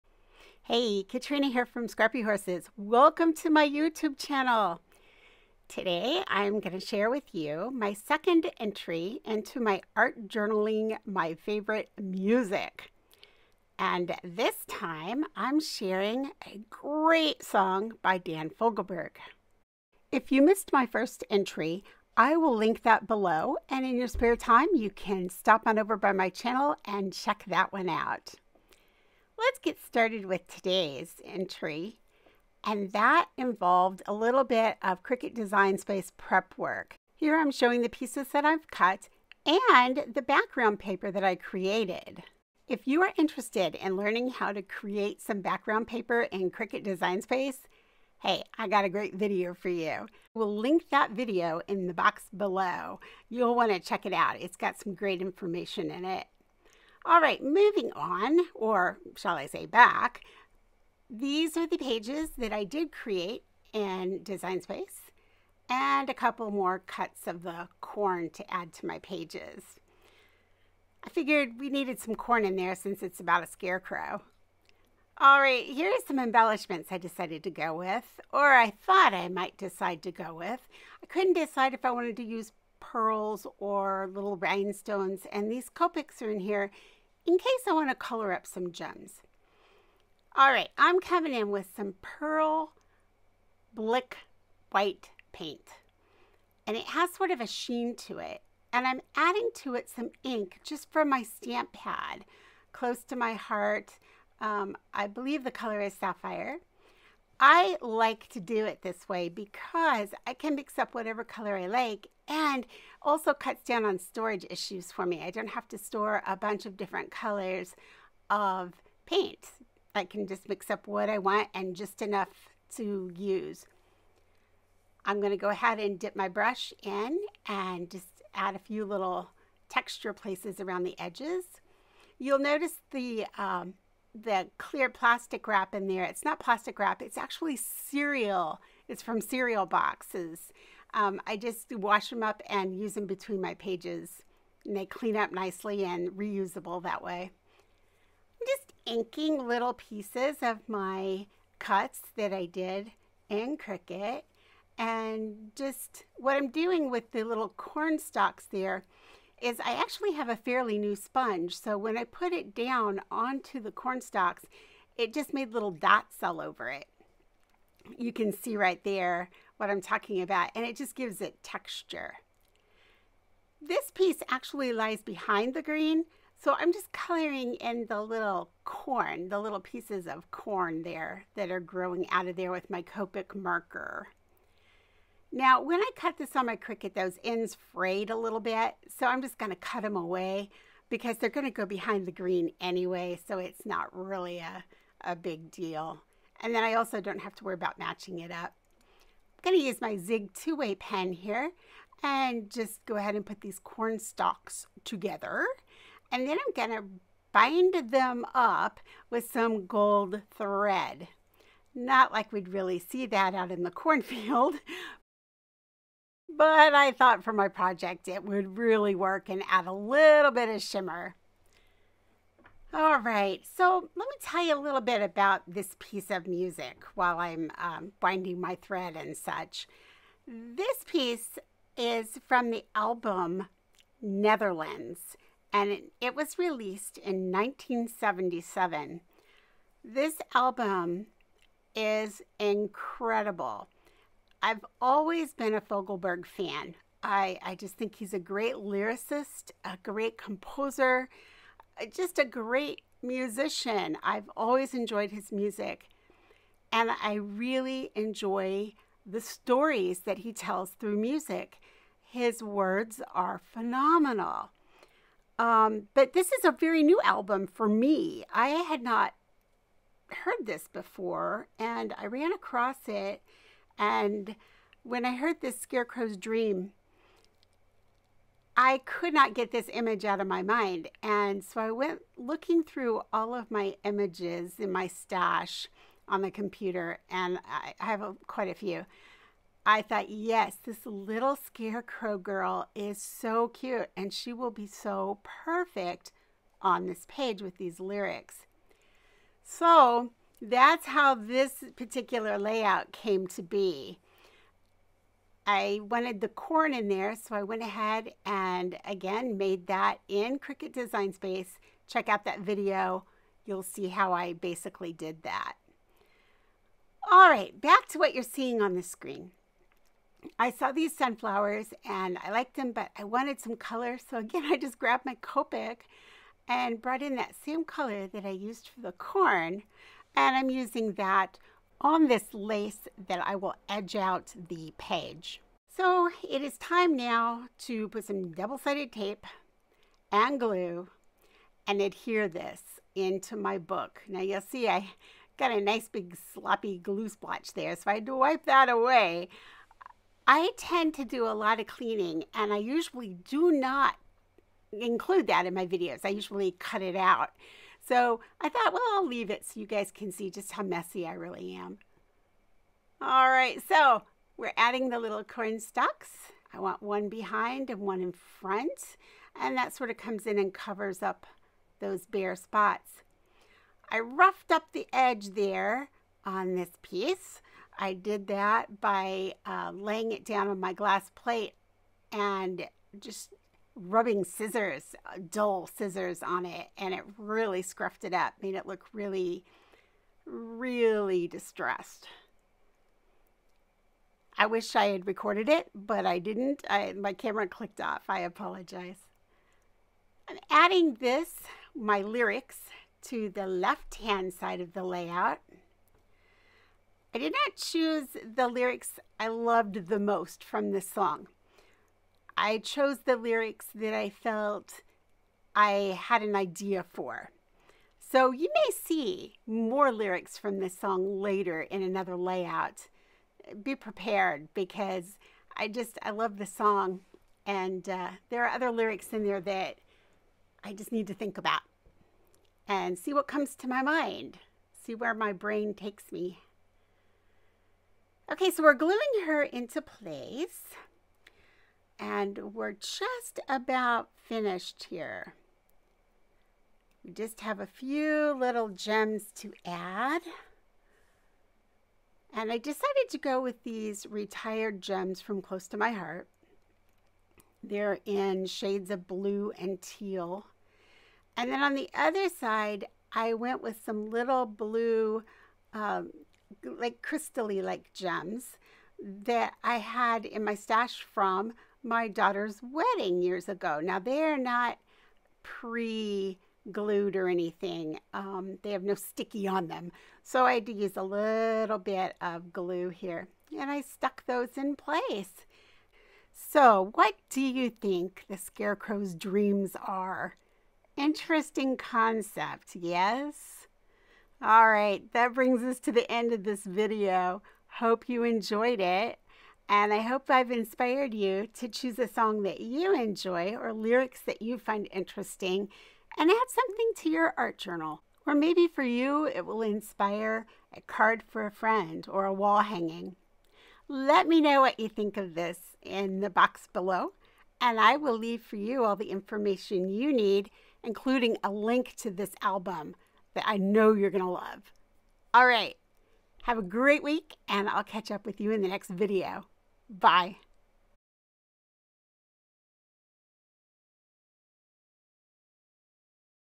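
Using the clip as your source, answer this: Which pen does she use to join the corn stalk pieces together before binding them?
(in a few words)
Zig two-way pen.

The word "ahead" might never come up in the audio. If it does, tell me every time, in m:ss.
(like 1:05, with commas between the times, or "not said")
2:05, 3:22, 5:07.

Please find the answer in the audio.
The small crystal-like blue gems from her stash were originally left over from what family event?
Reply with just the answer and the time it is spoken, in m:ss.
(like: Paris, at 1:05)
Daughter's wedding, at 7:51.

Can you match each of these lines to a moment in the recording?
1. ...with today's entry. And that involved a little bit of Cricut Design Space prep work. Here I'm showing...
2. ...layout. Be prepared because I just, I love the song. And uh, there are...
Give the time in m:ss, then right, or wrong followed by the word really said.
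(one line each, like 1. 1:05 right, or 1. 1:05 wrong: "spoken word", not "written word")
1. 0:30 right
2. 7:02 right.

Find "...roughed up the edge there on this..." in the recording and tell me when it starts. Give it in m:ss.
6:13.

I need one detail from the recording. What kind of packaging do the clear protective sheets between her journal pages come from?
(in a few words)
Cereal boxes.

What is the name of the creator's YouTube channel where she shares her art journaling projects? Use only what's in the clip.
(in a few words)
Scrappy Horses.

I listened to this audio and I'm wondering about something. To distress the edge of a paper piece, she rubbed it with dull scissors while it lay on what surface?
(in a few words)
Glass plate.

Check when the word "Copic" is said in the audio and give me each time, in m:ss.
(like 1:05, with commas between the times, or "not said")
1:25, 3:02, 5:25.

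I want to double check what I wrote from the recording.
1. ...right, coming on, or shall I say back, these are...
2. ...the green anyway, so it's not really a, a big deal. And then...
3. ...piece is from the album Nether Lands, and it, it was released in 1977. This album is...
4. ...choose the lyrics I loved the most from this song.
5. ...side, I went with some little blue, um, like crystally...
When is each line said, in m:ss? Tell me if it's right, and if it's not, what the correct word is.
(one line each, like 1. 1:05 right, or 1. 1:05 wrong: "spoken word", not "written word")
1. 0:57 wrong: "moving", not "coming"
2. 3:12 right
3. 3:50 right
4. 6:47 right
5. 7:42 right.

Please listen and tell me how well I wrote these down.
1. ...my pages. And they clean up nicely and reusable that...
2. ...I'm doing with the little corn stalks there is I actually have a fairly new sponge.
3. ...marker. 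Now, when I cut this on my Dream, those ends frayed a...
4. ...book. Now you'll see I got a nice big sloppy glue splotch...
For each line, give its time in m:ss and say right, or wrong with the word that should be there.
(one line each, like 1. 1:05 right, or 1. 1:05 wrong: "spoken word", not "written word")
1. 2:23 right
2. 2:36 right
3. 3:03 wrong: "Cricut", not "Dream"
4. 5:43 right.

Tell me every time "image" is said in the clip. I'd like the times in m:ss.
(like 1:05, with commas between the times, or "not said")
4:39, 4:43.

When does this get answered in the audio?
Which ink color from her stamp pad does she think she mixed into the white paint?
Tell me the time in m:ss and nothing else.
1:45.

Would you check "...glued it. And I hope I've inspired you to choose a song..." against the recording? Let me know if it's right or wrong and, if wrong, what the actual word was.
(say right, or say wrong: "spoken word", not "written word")
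wrong: "enjoyed", not "glued".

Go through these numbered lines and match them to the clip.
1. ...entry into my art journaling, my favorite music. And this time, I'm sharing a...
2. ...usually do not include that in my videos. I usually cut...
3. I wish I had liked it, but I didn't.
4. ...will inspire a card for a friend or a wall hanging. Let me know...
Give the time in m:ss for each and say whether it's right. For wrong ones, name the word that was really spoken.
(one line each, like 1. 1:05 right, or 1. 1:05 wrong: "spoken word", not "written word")
1. 0:08 right
2. 5:52 right
3. 6:34 wrong: "recorded", not "liked"
4. 8:29 right.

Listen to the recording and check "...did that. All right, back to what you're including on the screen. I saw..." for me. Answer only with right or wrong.
wrong.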